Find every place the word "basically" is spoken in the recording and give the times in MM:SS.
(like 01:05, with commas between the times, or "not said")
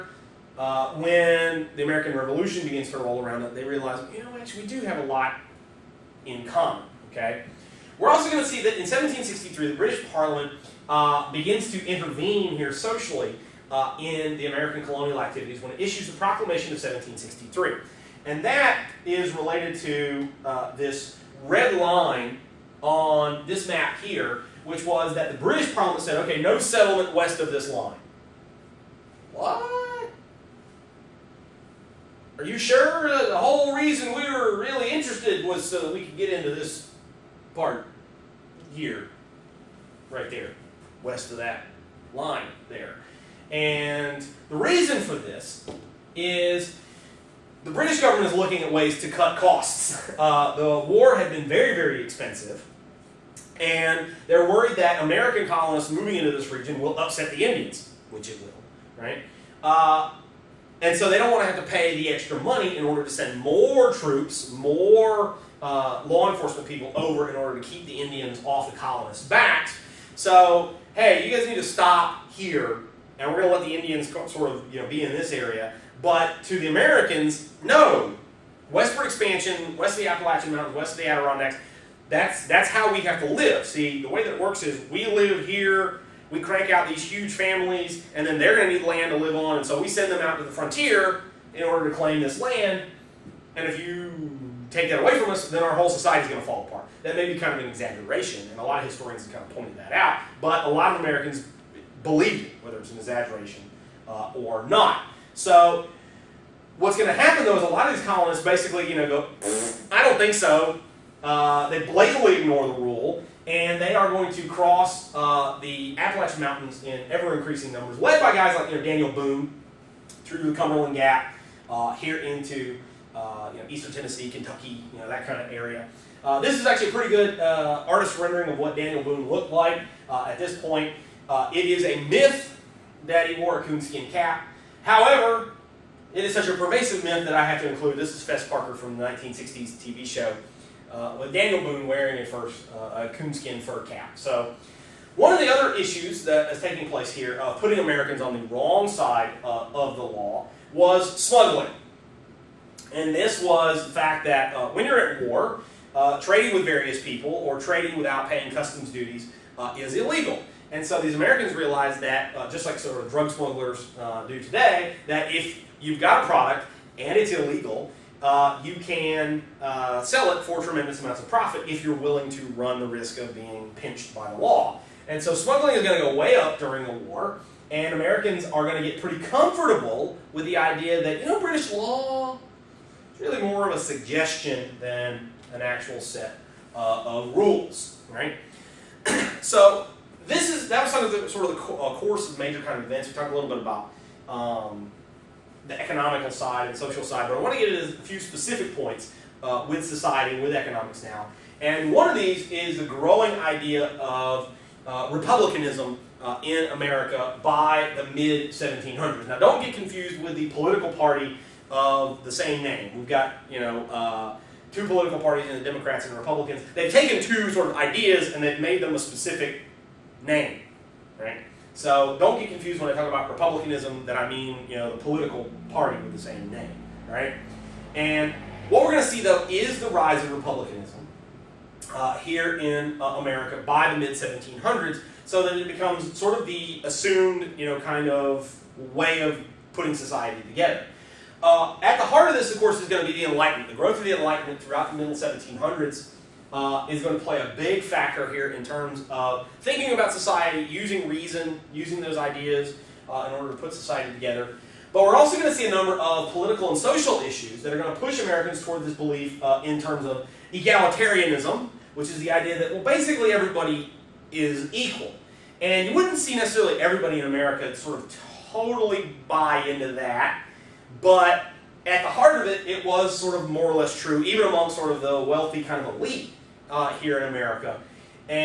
01:48, 04:22.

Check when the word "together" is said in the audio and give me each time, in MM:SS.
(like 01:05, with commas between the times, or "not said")
04:00, 04:14.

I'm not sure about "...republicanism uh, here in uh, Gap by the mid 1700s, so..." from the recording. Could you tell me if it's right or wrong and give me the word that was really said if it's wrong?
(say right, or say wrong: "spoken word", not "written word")
wrong: "America", not "Gap".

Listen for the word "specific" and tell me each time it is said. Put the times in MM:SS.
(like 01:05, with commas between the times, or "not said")
03:18, 03:38.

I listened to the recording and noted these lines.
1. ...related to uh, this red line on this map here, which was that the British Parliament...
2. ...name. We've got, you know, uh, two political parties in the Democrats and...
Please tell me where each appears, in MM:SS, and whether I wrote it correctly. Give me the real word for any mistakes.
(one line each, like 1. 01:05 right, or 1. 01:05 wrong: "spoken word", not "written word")
1. 00:19 right
2. 03:32 right.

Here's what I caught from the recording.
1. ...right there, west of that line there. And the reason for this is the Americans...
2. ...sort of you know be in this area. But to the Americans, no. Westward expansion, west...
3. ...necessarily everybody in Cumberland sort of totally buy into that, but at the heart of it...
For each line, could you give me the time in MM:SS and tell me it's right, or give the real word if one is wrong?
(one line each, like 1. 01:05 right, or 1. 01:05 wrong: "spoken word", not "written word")
1. 00:40 wrong: "British", not "Americans"
2. 01:14 right
3. 04:26 wrong: "America", not "Cumberland".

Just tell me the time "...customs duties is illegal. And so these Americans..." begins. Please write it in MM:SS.
02:38.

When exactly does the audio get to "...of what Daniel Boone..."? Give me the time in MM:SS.
02:08.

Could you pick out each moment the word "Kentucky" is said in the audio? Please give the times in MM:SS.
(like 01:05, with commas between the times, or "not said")
02:04.